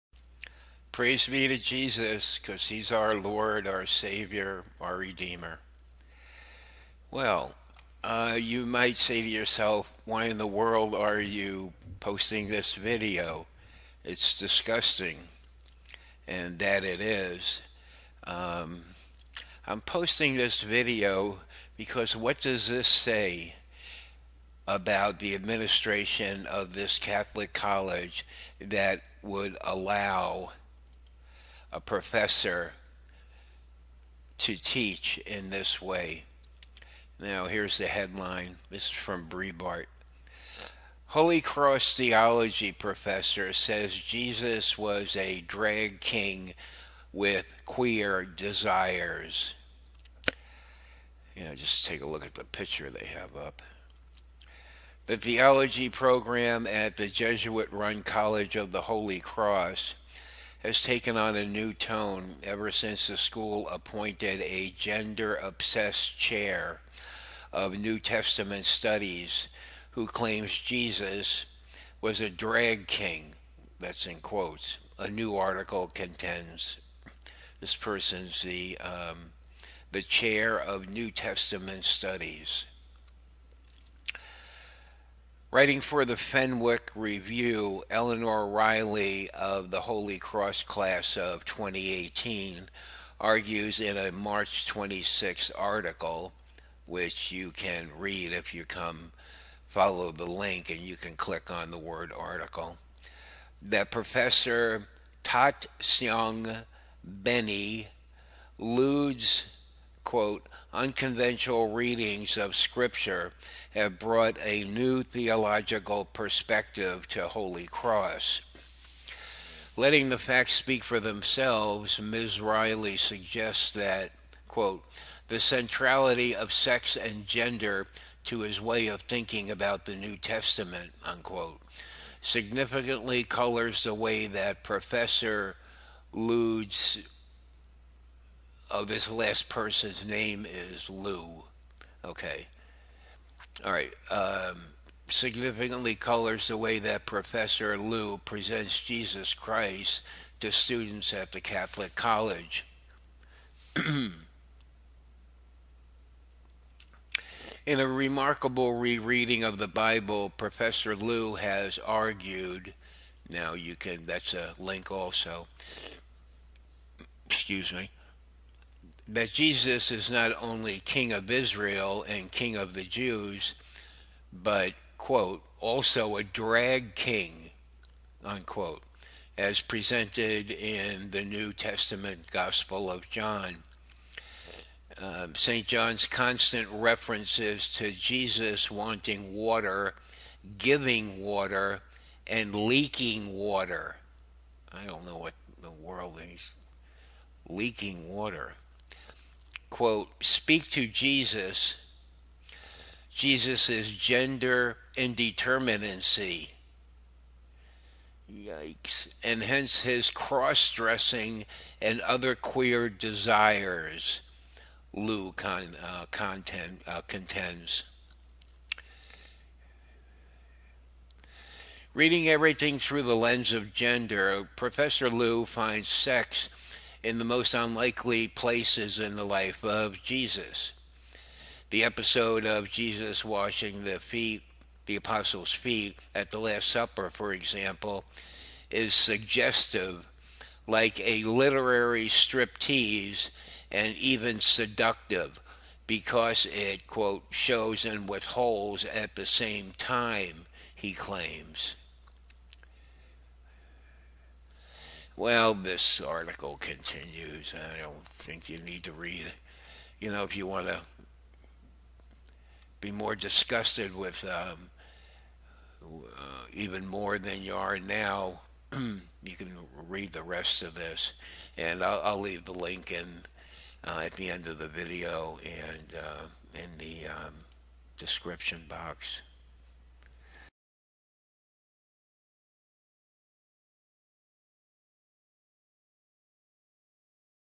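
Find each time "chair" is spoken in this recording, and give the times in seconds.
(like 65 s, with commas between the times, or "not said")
66 s, 80 s.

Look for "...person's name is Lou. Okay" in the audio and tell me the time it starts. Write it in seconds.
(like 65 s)
139 s.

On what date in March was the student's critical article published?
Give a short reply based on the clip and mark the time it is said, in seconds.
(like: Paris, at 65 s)
March 26, at 94 s.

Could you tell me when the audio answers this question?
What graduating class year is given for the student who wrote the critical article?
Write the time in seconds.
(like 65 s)
91 s.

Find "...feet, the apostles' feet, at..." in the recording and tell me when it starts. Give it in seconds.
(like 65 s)
233 s.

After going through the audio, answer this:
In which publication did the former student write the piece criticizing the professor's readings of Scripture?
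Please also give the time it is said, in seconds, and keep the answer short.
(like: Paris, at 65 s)
Fenwick Review, at 86 s.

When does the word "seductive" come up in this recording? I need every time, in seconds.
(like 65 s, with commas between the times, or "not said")
244 s.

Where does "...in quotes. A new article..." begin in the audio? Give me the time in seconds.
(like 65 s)
74 s.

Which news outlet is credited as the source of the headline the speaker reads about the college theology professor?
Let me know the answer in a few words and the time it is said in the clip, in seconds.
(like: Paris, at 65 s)
Breitbart, at 39 s.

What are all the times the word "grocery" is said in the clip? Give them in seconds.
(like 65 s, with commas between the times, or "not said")
not said.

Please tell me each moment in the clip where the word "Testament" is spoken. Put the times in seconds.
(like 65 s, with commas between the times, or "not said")
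67 s, 81 s, 130 s, 181 s.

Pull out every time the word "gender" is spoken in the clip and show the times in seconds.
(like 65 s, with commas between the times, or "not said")
64 s, 127 s, 203 s, 223 s.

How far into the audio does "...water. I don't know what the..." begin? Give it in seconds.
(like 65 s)
193 s.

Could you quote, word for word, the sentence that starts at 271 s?
And I'll, I'll leave the link in uh, at the end of the video and uh, in the um, description box.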